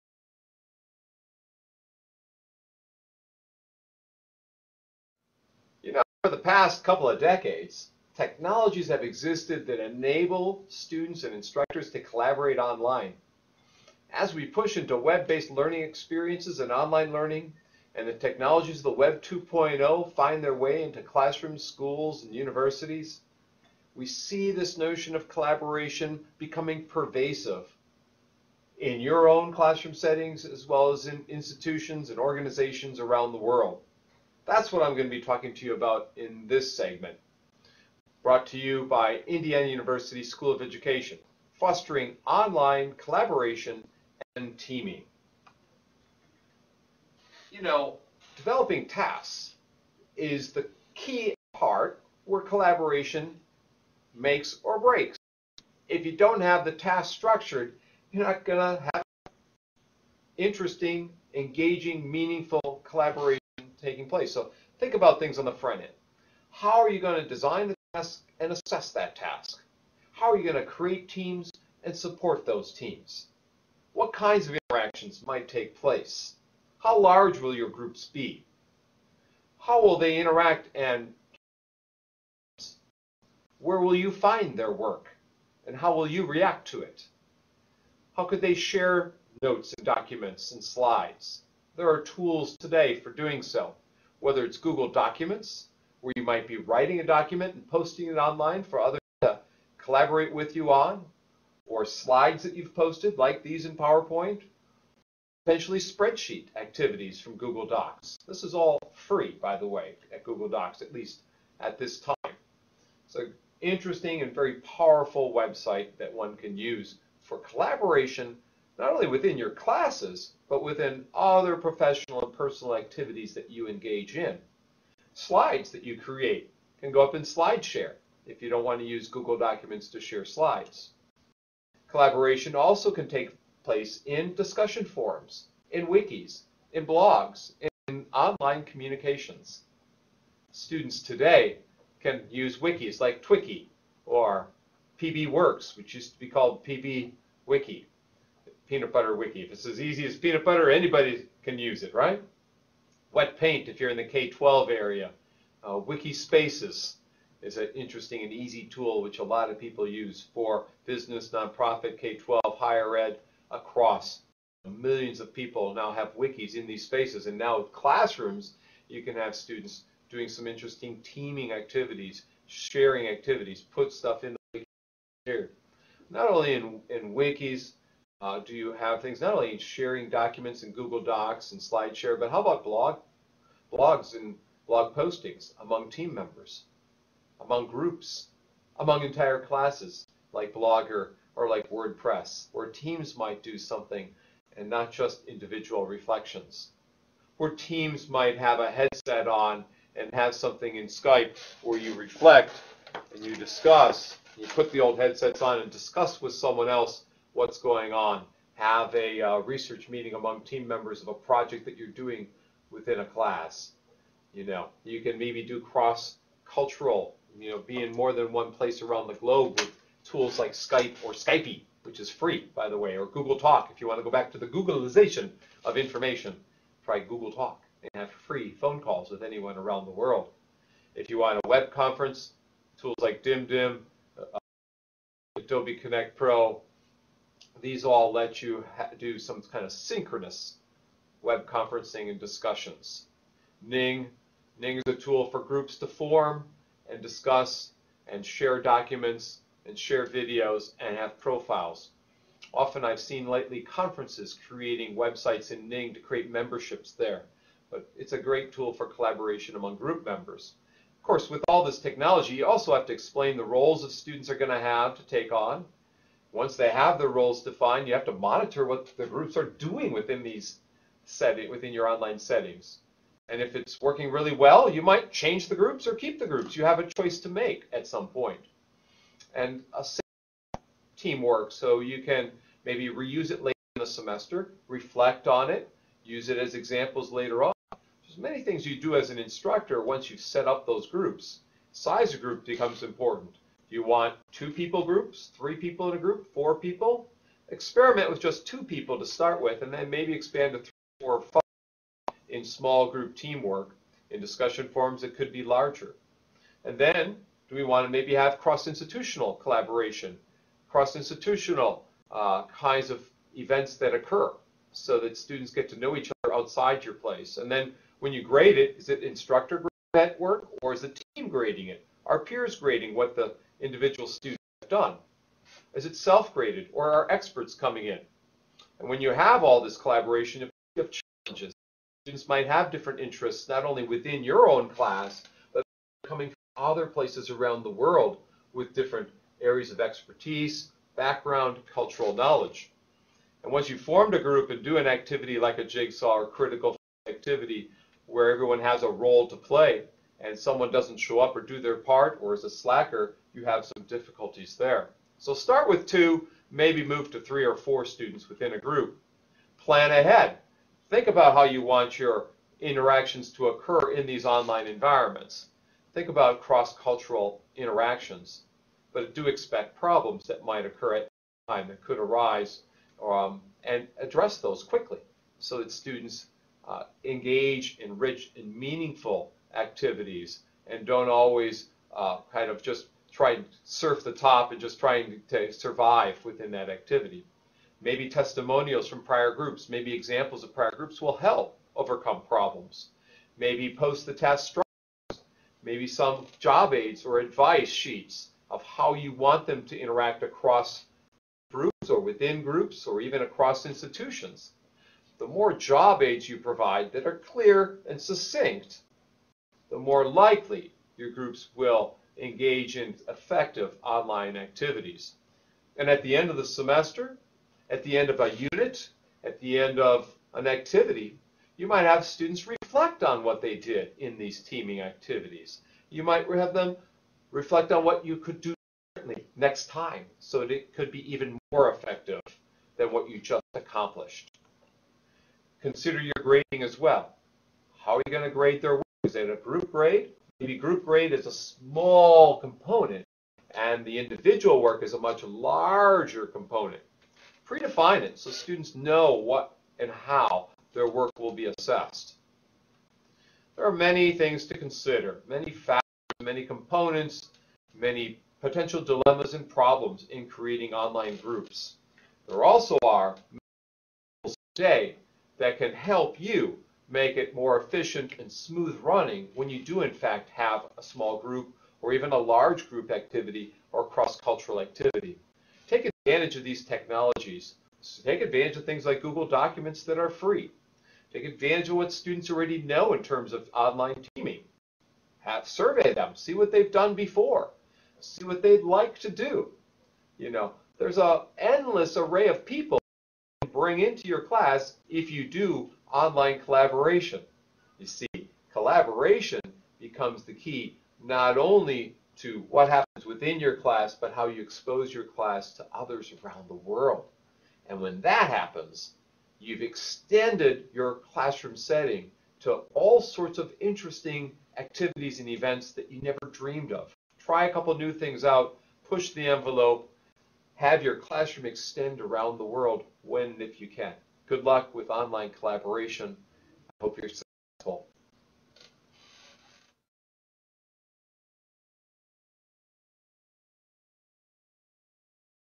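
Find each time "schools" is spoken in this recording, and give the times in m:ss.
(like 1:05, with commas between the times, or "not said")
0:21, 0:40.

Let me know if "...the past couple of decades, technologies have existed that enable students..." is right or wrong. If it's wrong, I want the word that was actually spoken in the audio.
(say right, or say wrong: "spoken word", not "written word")
right.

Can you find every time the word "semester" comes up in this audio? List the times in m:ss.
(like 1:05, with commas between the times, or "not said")
4:43, 6:56.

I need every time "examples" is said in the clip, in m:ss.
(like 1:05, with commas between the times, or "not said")
4:46, 6:29.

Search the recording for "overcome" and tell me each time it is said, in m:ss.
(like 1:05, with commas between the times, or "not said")
6:31.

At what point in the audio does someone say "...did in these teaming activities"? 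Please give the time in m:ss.
7:03.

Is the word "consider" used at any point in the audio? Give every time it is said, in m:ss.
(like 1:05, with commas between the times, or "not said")
7:15, 7:34.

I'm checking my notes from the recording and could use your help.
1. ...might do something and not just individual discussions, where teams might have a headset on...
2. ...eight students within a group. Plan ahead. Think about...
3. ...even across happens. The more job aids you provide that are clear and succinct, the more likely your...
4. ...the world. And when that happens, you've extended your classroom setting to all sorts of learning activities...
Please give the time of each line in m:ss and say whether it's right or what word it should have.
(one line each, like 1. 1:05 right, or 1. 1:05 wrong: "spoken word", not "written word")
1. 3:13 wrong: "reflections", not "discussions"
2. 5:57 wrong: "four", not "eight"
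3. 6:43 wrong: "institutions", not "happens"
4. 8:26 wrong: "interesting", not "learning".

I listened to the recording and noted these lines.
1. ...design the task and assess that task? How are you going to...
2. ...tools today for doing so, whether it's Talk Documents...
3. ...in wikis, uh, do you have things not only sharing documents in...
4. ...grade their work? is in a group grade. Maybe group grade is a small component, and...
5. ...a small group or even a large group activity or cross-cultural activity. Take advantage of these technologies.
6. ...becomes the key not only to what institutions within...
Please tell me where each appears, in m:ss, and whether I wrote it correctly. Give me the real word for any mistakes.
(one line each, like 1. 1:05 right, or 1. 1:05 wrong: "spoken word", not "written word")
1. 1:07 right
2. 1:32 wrong: "Google", not "Talk"
3. 2:56 right
4. 7:18 right
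5. 7:50 right
6. 8:19 wrong: "happens", not "institutions".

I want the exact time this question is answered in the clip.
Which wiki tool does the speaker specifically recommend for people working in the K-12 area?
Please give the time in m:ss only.
2:33.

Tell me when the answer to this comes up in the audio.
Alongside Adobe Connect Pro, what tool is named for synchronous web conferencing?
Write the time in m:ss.
3:53.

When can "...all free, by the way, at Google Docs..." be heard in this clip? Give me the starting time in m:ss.
1:48.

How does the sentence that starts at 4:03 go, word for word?
Ning, Ning is a tool for groups to form and discuss and share documents and share videos and have profiles.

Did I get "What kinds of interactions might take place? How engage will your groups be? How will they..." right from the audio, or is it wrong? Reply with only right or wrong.
wrong.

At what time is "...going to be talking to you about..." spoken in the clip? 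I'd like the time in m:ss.
0:34.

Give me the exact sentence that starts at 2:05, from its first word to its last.
Slides that you create can go up in SlideShare if you don't want to use Google Documents to share slides.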